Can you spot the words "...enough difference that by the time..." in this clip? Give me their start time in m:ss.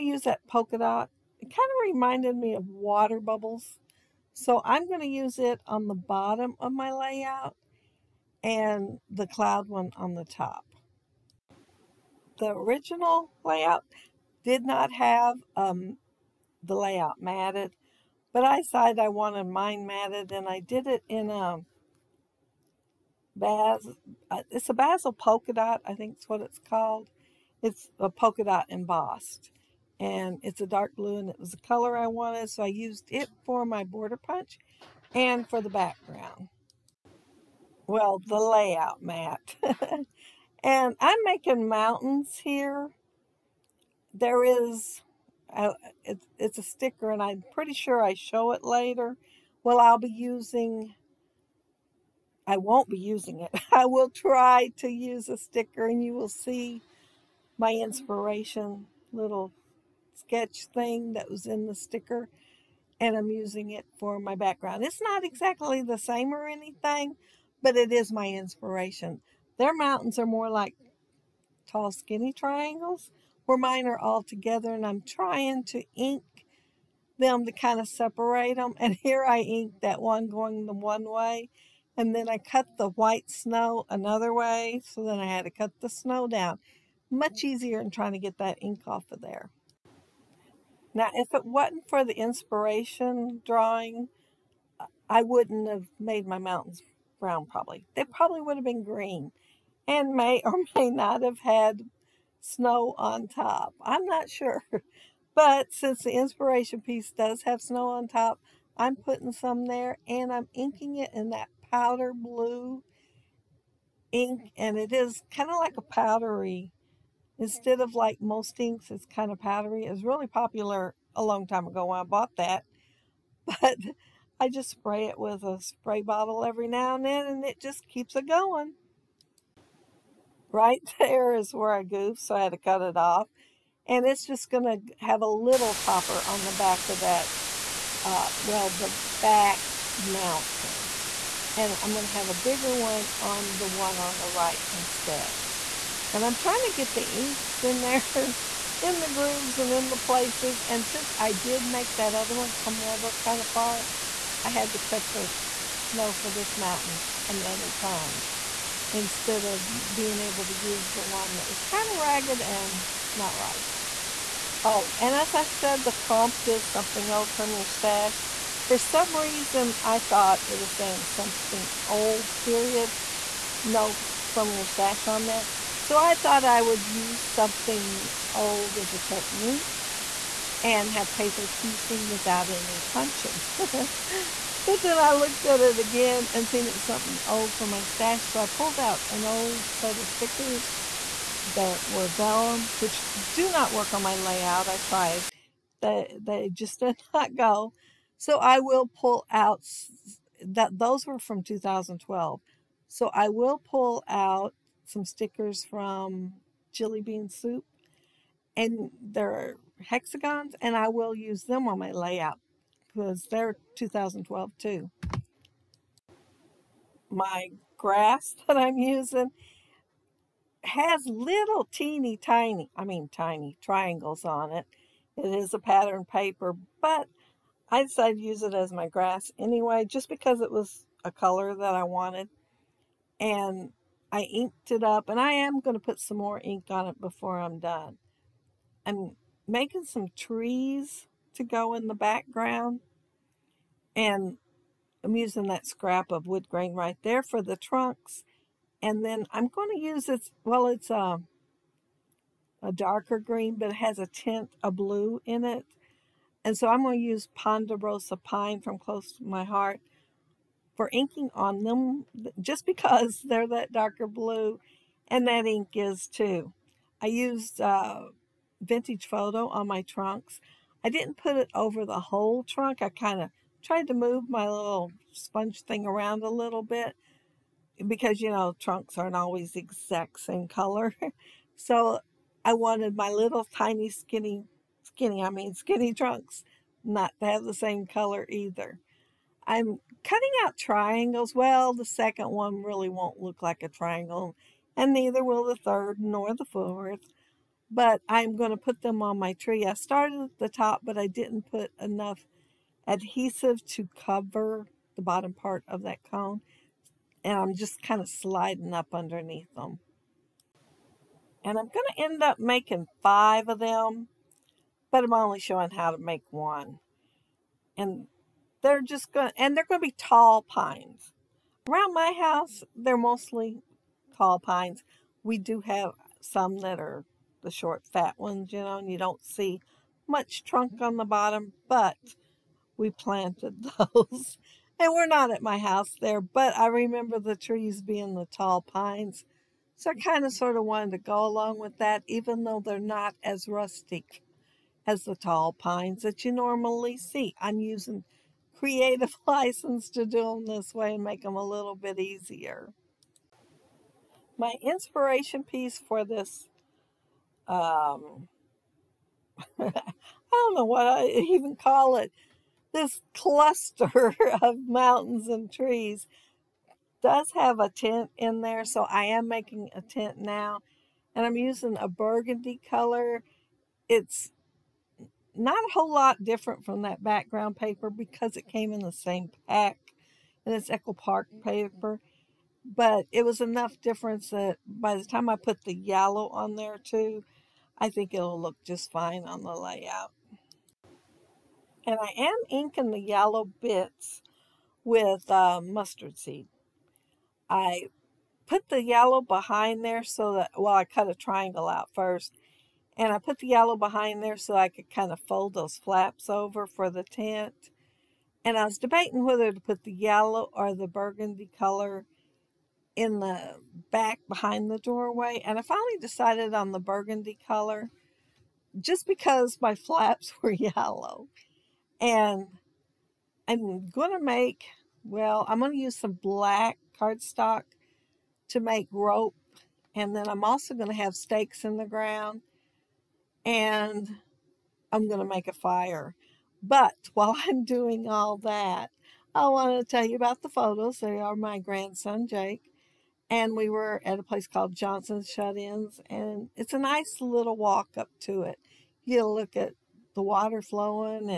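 6:23.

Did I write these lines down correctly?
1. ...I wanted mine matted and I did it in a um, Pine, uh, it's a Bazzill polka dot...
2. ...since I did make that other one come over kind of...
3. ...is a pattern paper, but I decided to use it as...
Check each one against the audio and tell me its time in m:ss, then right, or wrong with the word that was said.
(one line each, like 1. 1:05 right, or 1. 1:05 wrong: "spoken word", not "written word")
1. 0:18 wrong: "Baz", not "Pine"
2. 2:30 right
3. 3:45 right.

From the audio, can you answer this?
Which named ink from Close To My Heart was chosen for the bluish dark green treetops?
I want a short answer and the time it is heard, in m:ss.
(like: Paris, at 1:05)
Ponderosa Pine, at 4:17.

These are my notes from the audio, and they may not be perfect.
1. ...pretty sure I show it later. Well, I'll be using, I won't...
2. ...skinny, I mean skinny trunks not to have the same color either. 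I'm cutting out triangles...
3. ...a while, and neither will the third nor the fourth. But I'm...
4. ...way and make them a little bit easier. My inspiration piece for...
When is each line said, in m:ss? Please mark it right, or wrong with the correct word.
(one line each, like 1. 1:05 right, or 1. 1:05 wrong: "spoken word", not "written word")
1. 0:47 right
2. 4:44 right
3. 4:53 wrong: "triangle", not "while"
4. 5:50 right.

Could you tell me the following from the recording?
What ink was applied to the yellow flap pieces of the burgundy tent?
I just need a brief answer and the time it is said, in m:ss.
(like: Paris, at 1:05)
Mustard Seed, at 6:35.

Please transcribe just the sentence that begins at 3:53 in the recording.
And I inked it up and I am going to put some more ink on it before I'm done.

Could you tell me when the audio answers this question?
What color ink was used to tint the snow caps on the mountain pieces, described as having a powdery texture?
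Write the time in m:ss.
1:51.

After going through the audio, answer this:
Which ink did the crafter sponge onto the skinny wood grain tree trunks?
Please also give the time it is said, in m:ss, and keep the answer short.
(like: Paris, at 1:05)
Vintage Photo, at 4:28.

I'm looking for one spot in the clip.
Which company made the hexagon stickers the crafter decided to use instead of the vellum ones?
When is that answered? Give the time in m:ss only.
3:26.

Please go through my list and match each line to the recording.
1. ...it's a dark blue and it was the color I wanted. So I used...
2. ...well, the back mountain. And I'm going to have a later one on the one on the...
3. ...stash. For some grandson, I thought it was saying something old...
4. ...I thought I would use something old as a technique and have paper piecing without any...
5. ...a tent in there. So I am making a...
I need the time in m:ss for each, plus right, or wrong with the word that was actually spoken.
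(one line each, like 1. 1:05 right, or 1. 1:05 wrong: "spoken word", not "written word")
1. 0:30 right
2. 2:18 wrong: "bigger", not "later"
3. 2:47 wrong: "reason", not "grandson"
4. 2:55 right
5. 6:07 right.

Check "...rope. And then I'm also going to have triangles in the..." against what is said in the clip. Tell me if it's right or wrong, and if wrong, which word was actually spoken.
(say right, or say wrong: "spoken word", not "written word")
wrong: "stakes", not "triangles".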